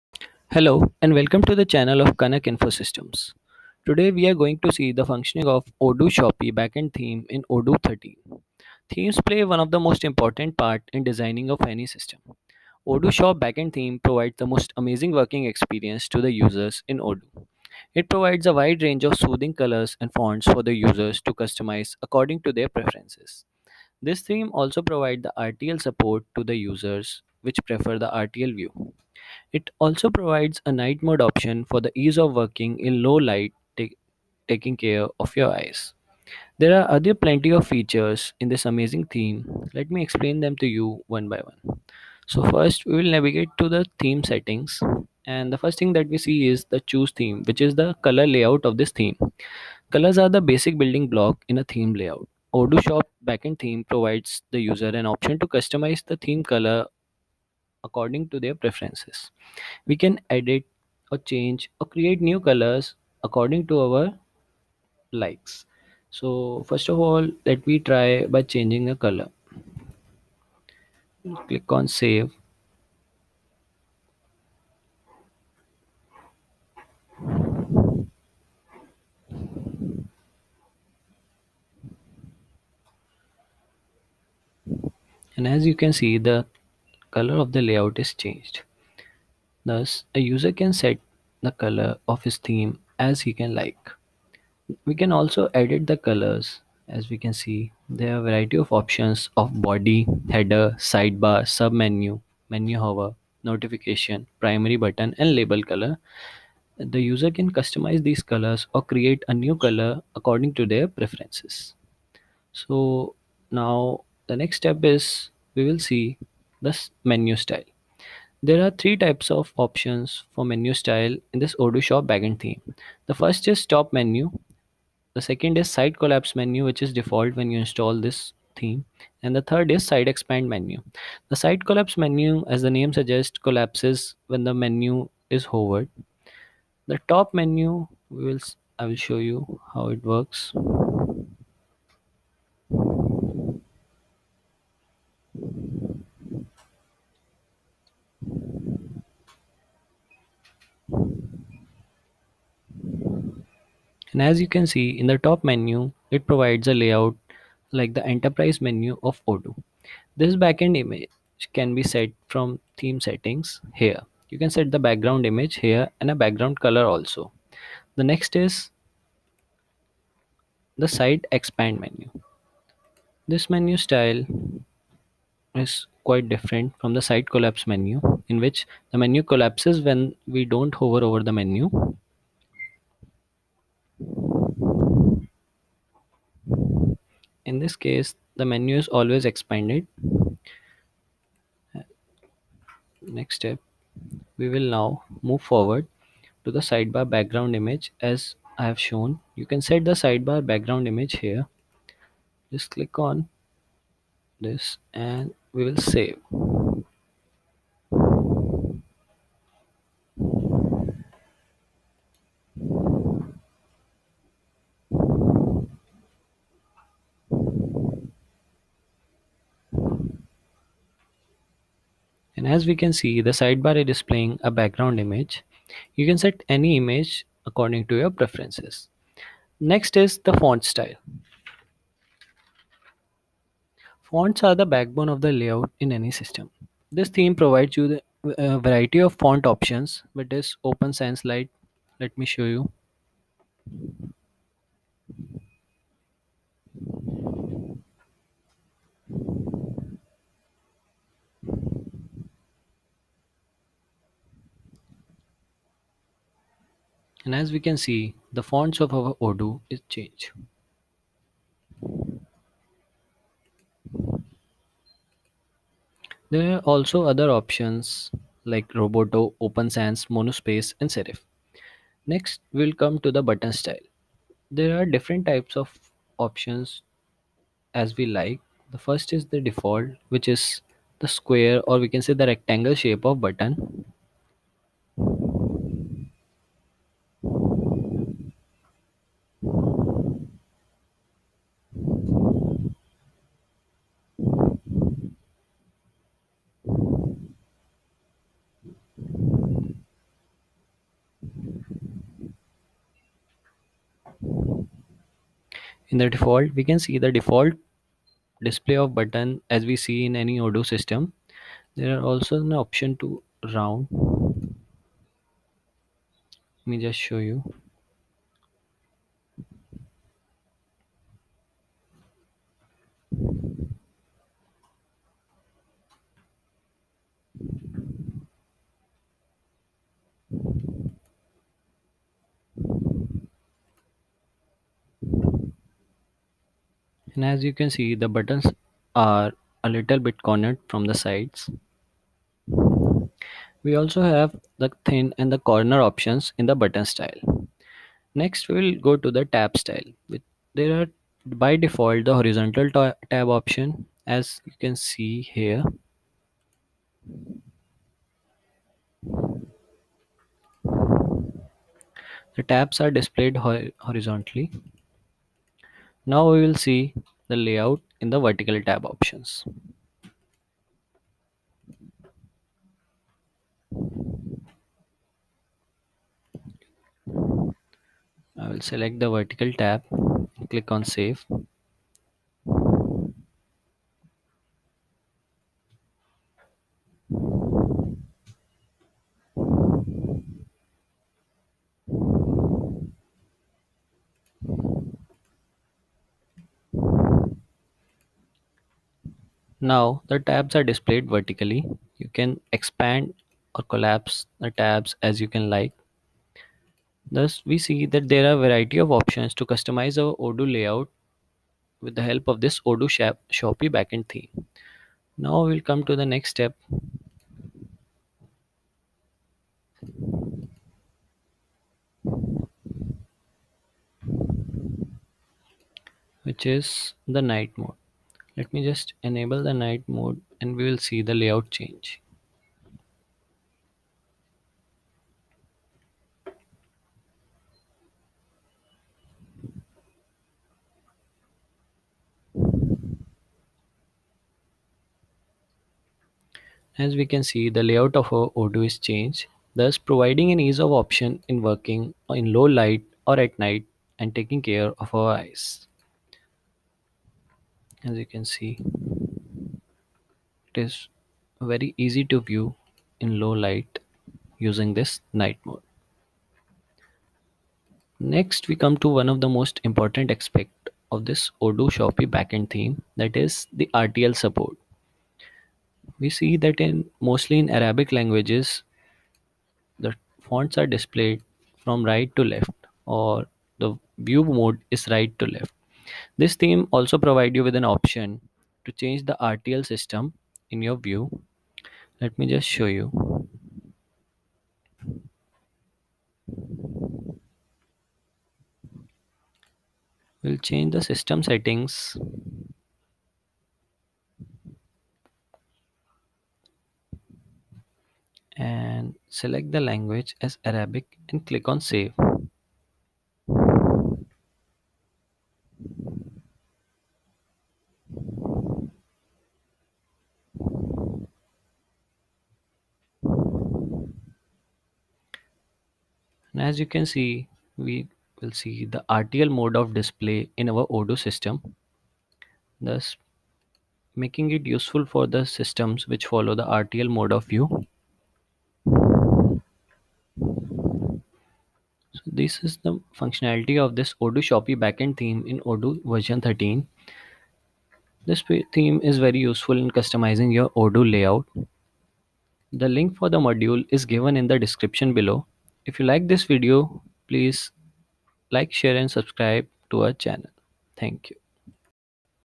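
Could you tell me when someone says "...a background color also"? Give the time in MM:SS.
02:46.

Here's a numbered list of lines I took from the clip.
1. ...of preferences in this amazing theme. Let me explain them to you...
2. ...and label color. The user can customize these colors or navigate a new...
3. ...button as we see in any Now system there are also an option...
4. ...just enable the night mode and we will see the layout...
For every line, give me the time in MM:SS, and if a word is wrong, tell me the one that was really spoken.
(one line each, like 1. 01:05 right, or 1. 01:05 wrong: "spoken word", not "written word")
1. 00:37 wrong: "features", not "preferences"
2. 01:45 wrong: "create", not "navigate"
3. 05:08 wrong: "Odoo", not "Now"
4. 07:08 right.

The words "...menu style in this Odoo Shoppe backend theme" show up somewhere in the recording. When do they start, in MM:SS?
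02:00.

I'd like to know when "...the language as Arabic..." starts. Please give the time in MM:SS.
08:29.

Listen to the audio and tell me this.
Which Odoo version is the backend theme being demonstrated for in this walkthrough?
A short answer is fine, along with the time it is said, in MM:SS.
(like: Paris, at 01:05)
Odoo 13, at 00:07.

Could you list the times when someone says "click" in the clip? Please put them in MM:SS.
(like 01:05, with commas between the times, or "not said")
01:11, 03:22, 06:20, 08:31.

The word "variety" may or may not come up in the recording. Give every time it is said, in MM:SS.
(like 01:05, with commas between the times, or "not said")
01:38, 03:58, 06:48.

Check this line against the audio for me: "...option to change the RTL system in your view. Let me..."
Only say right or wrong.
right.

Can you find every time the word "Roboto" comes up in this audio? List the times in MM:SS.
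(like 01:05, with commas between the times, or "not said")
04:28.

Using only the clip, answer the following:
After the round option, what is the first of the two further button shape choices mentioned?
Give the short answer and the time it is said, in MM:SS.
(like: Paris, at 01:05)
Thin, at 05:44.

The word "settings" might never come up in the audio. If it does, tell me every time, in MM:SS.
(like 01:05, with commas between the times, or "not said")
00:44, 02:42, 08:21.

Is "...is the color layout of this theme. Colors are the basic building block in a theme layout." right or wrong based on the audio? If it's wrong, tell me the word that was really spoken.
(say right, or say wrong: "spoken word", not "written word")
right.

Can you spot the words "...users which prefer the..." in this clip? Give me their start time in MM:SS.
00:26.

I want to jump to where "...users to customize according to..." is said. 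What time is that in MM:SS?
00:20.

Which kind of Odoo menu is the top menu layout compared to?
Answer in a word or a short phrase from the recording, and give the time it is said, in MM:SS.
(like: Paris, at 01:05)
Enterprise menu, at 02:38.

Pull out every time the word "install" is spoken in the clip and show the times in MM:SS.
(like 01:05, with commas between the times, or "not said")
02:07.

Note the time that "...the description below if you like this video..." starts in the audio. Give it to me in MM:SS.
09:14.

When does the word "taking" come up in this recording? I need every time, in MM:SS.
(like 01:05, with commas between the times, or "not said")
00:34, 07:34.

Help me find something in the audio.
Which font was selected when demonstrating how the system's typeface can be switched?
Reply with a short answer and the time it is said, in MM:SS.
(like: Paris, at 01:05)
Open Sans Light, at 04:00.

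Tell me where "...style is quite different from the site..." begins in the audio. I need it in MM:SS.
02:53.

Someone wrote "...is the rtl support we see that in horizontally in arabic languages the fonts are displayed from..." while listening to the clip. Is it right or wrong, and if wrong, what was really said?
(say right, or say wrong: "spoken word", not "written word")
wrong: "mostly", not "horizontally".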